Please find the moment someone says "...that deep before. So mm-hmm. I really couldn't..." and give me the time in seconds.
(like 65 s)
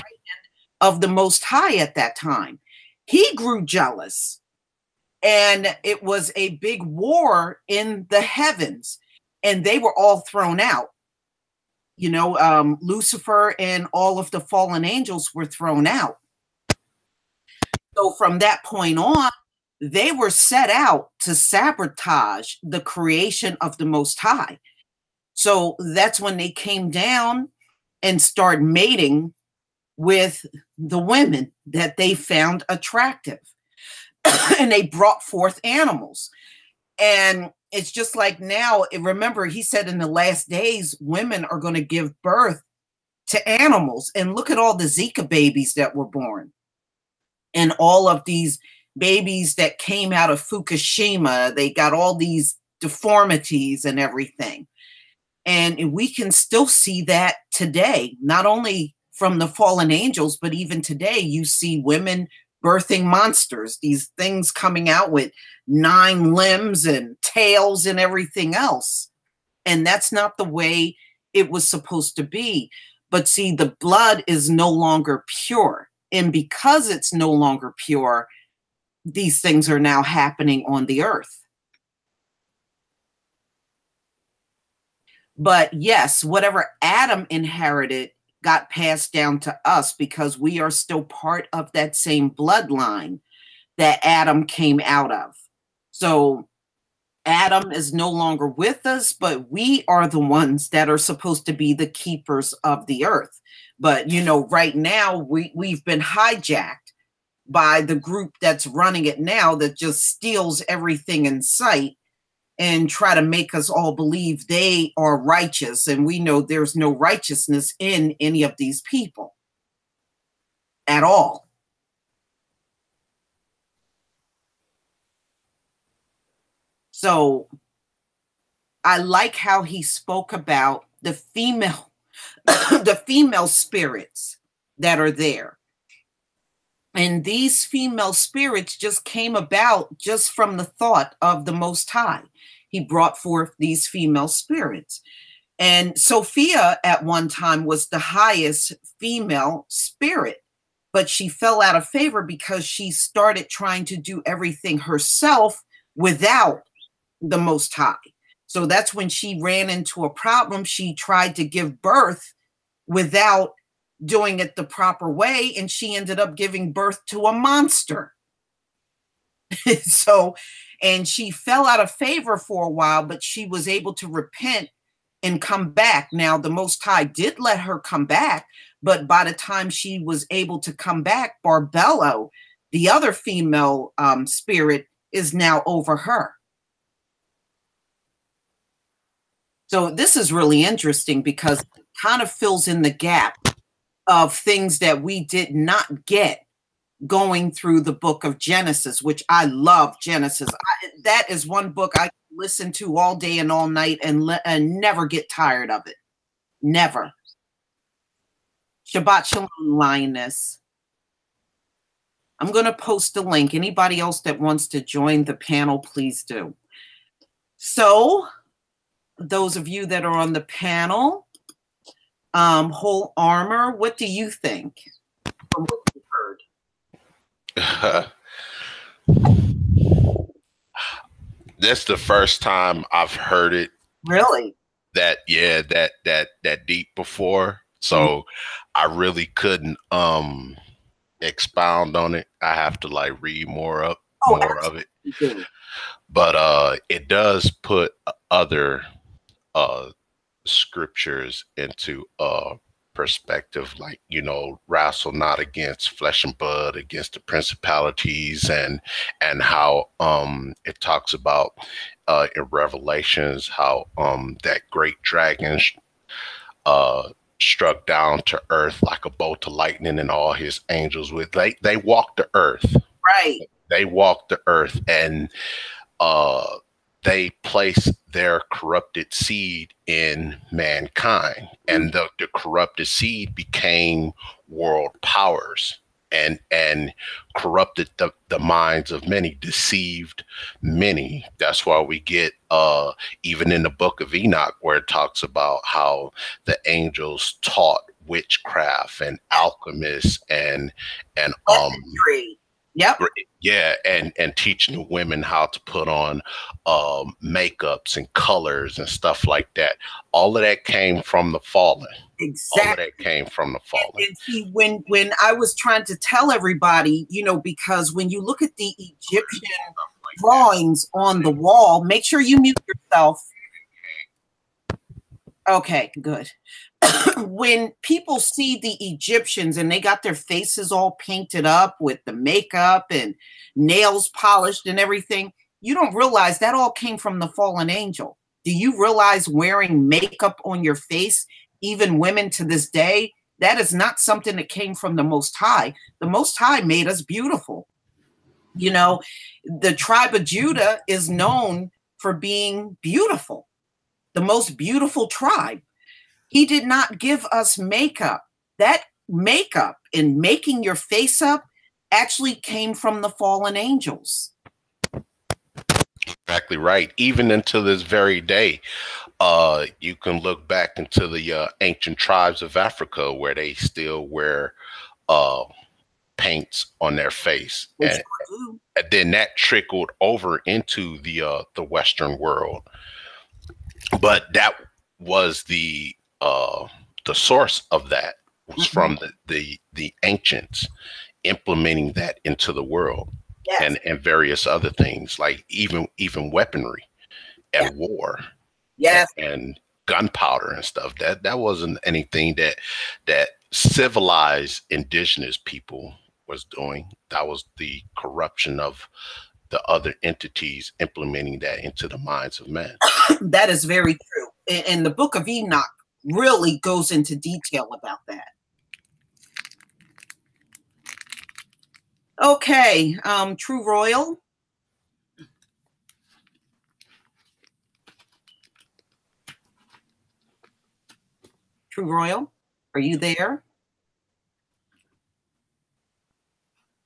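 236 s.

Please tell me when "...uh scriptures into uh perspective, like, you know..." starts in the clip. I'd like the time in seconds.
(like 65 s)
249 s.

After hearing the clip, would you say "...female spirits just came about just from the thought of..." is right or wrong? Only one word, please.
right.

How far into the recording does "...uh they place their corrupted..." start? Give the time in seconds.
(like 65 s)
275 s.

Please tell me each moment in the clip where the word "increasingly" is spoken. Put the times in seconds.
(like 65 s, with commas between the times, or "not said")
not said.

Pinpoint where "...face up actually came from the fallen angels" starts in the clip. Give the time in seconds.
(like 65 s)
360 s.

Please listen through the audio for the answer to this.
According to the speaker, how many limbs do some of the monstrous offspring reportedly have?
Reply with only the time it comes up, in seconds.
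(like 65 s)
65 s.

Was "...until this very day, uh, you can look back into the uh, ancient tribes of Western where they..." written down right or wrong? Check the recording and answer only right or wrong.
wrong.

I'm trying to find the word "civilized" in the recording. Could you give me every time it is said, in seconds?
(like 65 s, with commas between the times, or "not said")
403 s.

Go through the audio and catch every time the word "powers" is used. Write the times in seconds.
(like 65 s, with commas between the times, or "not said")
285 s.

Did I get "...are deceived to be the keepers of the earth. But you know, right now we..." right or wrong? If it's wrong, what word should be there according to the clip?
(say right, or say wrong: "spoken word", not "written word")
wrong: "supposed", not "deceived".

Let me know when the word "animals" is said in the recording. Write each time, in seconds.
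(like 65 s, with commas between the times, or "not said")
35 s, 43 s.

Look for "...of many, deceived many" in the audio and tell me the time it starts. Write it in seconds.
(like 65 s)
288 s.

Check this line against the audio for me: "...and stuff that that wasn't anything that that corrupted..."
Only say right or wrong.
wrong.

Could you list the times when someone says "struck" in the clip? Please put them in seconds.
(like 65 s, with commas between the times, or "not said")
267 s.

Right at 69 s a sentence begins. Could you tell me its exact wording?
And that's not the way it was supposed to be.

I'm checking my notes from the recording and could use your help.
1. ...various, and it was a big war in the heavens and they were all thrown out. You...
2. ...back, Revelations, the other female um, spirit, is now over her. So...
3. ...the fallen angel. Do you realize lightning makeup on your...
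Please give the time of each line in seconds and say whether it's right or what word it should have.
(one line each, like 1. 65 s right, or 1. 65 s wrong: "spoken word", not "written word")
1. 3 s wrong: "jealous", not "various"
2. 181 s wrong: "Barbelo", not "Revelations"
3. 337 s wrong: "wearing", not "lightning".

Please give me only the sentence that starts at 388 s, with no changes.
from the, the, the ancients implementing that into the world yes.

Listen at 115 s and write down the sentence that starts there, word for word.
And we know there's no righteousness in any of these people at all.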